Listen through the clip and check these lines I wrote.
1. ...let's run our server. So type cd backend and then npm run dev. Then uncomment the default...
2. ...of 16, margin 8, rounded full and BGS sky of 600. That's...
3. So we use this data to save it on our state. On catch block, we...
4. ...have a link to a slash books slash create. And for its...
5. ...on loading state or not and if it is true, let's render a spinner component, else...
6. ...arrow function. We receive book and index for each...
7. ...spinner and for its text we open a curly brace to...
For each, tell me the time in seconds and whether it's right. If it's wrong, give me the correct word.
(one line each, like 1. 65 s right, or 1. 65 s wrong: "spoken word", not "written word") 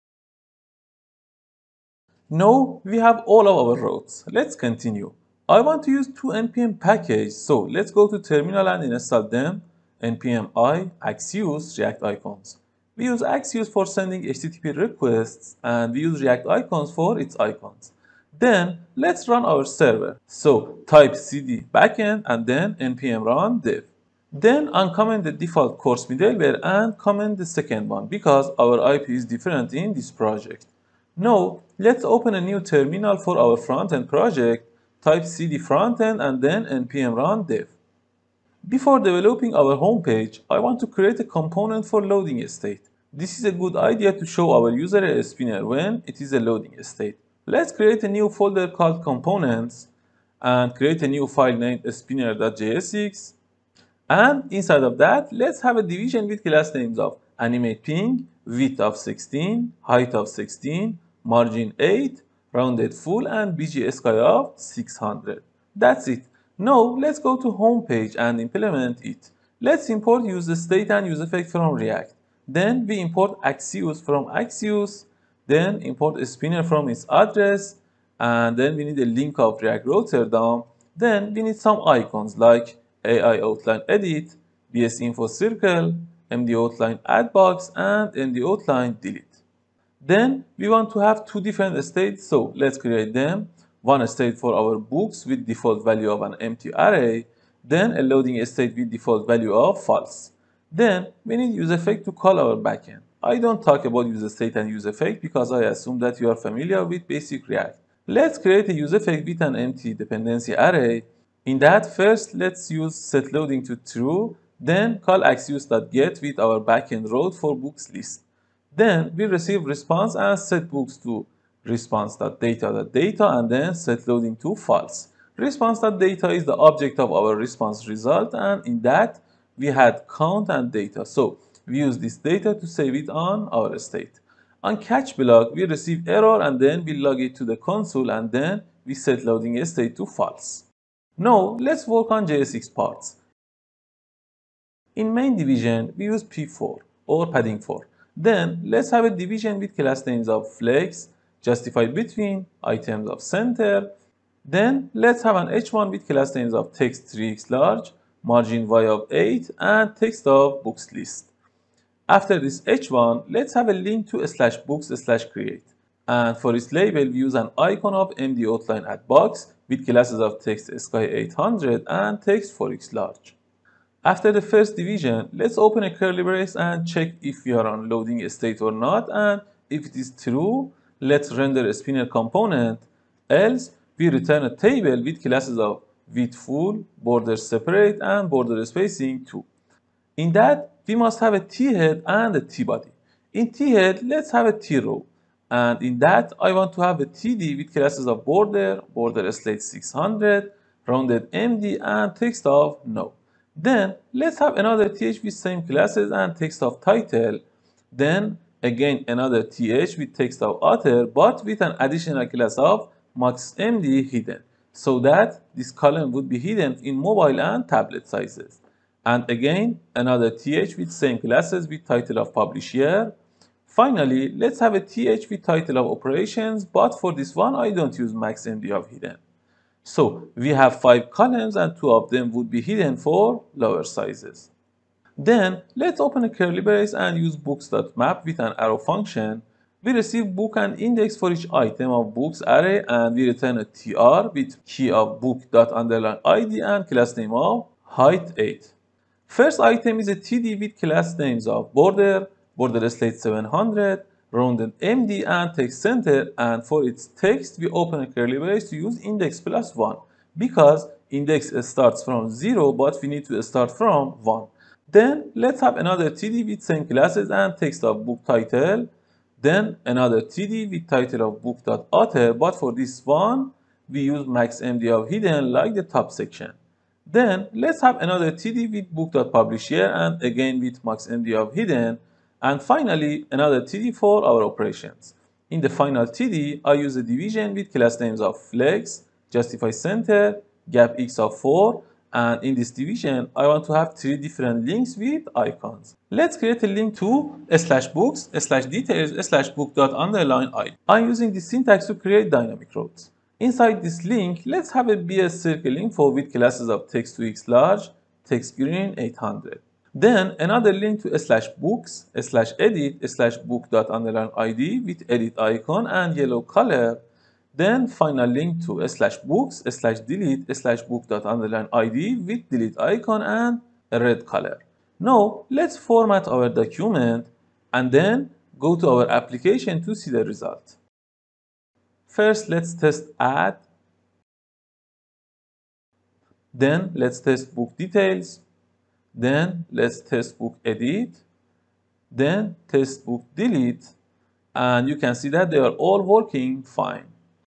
1. 18 s right
2. 60 s right
3. 131 s right
4. 163 s right
5. 177 s right
6. 238 s right
7. 255 s wrong: "center", not "spinner".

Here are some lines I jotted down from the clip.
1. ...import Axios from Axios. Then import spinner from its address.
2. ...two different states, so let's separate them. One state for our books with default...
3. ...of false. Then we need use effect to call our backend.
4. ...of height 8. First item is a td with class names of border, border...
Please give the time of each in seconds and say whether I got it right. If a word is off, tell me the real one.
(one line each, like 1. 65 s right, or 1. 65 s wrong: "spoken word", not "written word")
1. 72 s right
2. 91 s wrong: "create", not "separate"
3. 99 s right
4. 247 s right.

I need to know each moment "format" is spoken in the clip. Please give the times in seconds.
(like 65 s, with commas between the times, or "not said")
325 s.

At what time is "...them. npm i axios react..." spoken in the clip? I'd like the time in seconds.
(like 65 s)
9 s.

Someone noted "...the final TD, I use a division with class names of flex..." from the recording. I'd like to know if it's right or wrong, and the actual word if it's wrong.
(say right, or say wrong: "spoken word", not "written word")
right.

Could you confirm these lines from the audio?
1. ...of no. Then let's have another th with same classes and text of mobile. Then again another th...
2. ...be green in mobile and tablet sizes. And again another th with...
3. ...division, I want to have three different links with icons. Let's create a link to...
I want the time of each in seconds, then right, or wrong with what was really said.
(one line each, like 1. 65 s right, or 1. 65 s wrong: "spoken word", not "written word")
1. 202 s wrong: "title", not "mobile"
2. 216 s wrong: "hidden", not "green"
3. 292 s right.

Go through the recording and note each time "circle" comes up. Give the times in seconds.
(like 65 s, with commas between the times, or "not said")
85 s, 305 s.